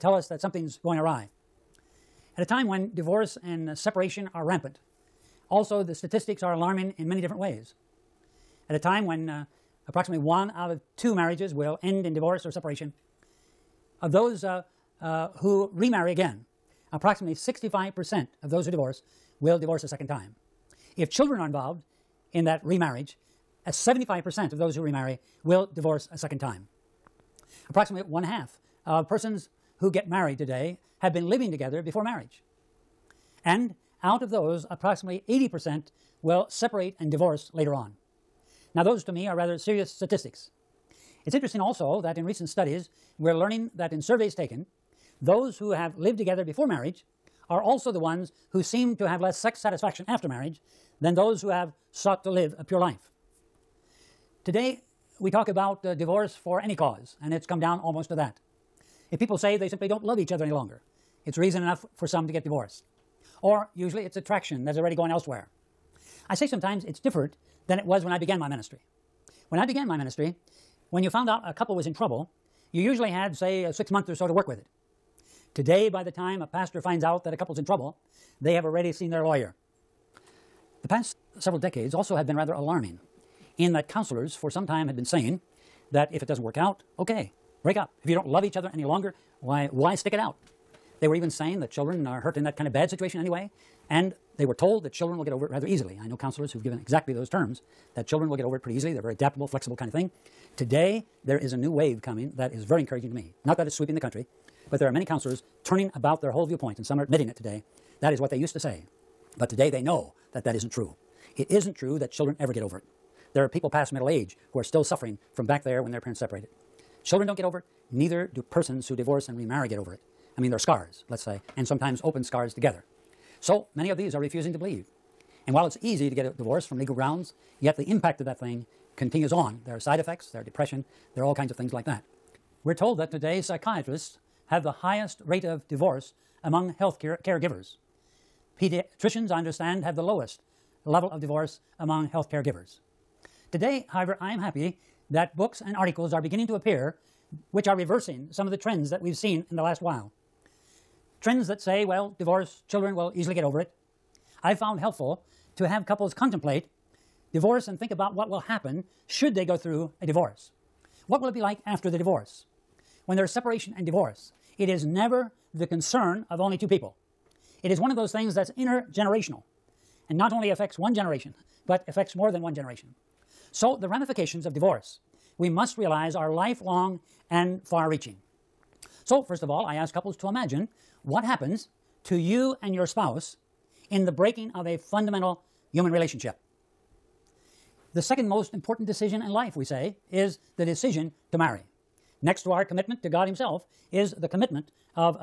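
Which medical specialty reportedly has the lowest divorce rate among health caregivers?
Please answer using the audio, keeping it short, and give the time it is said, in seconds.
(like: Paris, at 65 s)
Pediatricians, at 138 s.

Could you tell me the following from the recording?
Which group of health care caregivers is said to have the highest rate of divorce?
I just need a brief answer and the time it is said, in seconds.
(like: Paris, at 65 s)
Psychiatrists, at 133 s.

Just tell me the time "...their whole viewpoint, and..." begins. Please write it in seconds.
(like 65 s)
106 s.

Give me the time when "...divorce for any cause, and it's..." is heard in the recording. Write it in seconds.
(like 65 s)
55 s.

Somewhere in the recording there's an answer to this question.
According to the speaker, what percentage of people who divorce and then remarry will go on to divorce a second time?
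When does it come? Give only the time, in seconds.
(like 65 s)
17 s.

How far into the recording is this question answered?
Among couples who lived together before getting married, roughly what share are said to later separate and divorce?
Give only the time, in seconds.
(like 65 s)
35 s.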